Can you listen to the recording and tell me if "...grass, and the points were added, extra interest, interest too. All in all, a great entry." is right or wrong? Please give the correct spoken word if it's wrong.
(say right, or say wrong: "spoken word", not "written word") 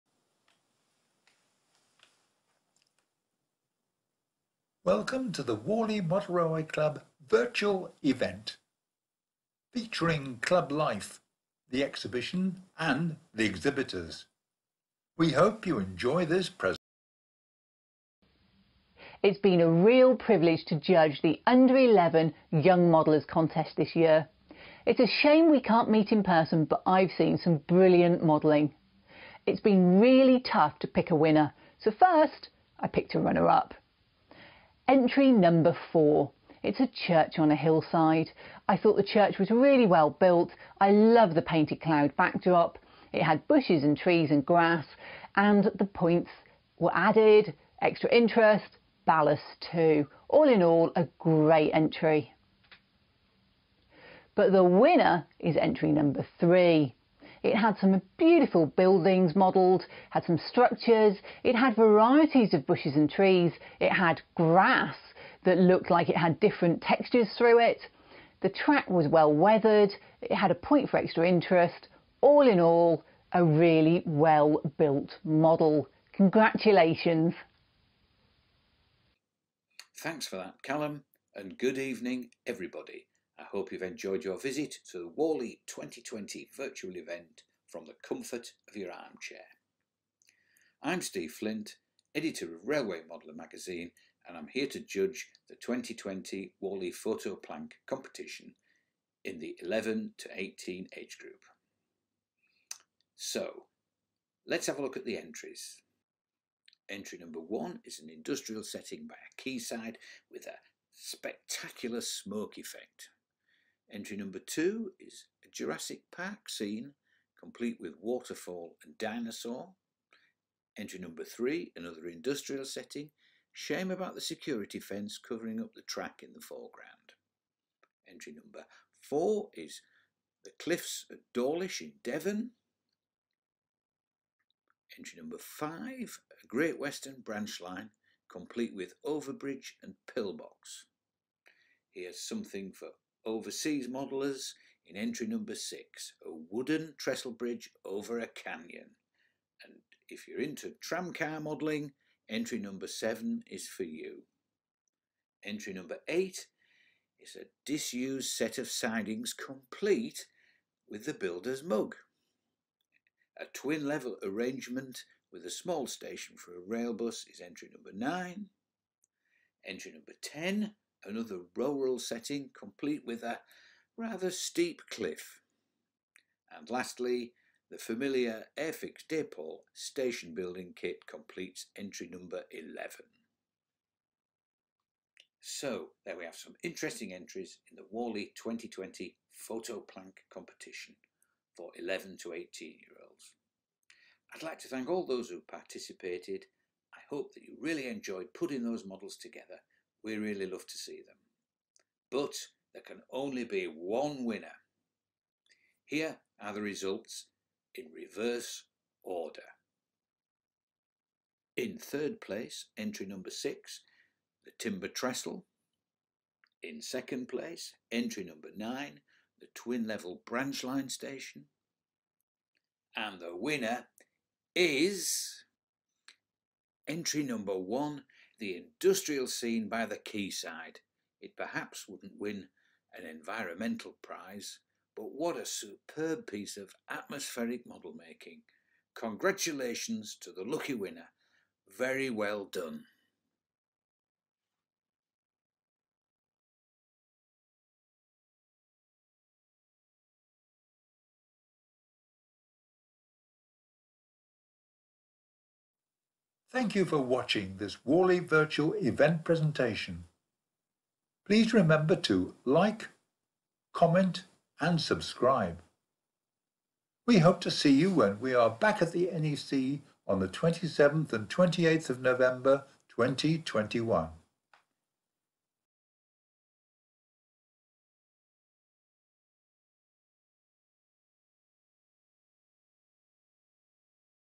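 wrong: "ballast", not "interest".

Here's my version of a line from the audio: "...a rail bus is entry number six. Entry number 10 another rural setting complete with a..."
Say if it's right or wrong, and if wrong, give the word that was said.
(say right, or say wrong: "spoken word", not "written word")
wrong: "nine", not "six".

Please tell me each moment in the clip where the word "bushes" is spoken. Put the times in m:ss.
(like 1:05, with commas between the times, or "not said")
0:43, 1:02.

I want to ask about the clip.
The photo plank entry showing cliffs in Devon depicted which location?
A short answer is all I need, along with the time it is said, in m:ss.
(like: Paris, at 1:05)
Dawlish, at 2:11.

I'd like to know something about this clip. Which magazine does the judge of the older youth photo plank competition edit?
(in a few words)
Railway Modeller.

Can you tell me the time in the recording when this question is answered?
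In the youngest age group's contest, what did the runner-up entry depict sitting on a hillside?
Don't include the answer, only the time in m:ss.
0:36.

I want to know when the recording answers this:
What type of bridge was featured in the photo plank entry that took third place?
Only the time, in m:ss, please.
3:34.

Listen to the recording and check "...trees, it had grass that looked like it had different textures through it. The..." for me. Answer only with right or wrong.
right.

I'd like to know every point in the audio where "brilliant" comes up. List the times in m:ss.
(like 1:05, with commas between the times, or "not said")
0:27.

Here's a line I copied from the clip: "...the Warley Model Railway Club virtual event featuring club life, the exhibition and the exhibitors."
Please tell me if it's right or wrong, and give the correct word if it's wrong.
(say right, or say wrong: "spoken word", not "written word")
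right.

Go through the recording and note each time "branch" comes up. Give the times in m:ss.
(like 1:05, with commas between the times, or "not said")
2:17, 3:40.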